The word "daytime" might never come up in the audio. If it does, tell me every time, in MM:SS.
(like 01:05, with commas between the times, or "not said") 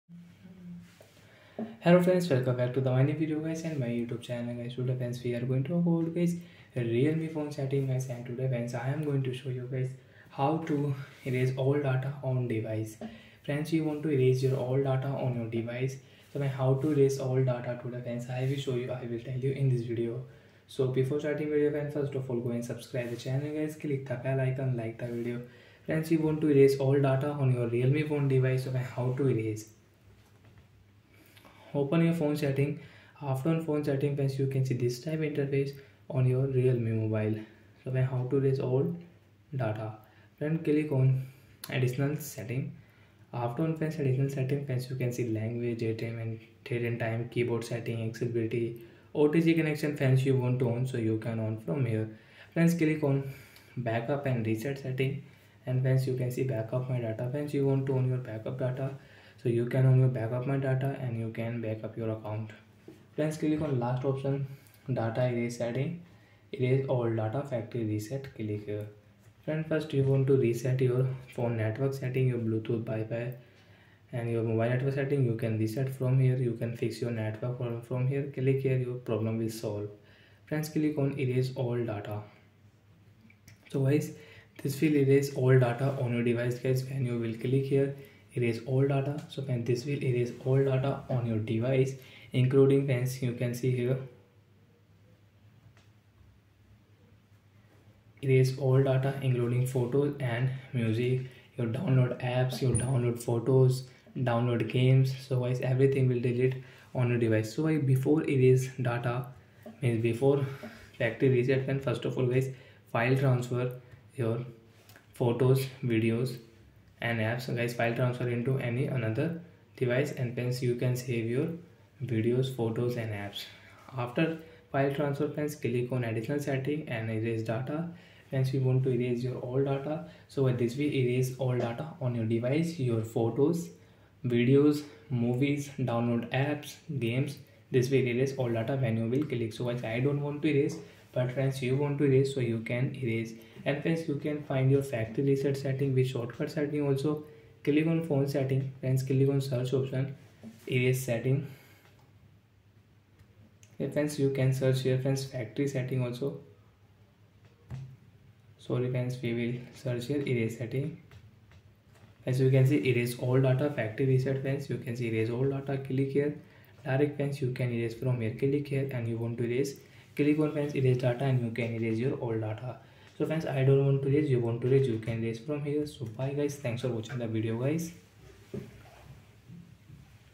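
00:45.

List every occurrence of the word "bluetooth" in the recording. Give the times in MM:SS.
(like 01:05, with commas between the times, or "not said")
01:12.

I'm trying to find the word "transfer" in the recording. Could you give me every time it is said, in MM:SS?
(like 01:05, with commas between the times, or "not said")
01:53, 01:57, 02:04.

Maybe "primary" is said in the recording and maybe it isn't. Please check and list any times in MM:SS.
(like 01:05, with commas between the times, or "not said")
not said.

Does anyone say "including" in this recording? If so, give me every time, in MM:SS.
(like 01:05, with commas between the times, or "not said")
01:32, 01:39.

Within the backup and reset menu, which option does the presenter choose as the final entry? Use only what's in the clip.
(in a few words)
Data erase setting.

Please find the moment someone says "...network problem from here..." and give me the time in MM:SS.
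01:17.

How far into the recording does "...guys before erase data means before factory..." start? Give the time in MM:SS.
01:47.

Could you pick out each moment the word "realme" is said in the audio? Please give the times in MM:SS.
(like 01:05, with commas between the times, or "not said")
00:06, 00:27, 00:36.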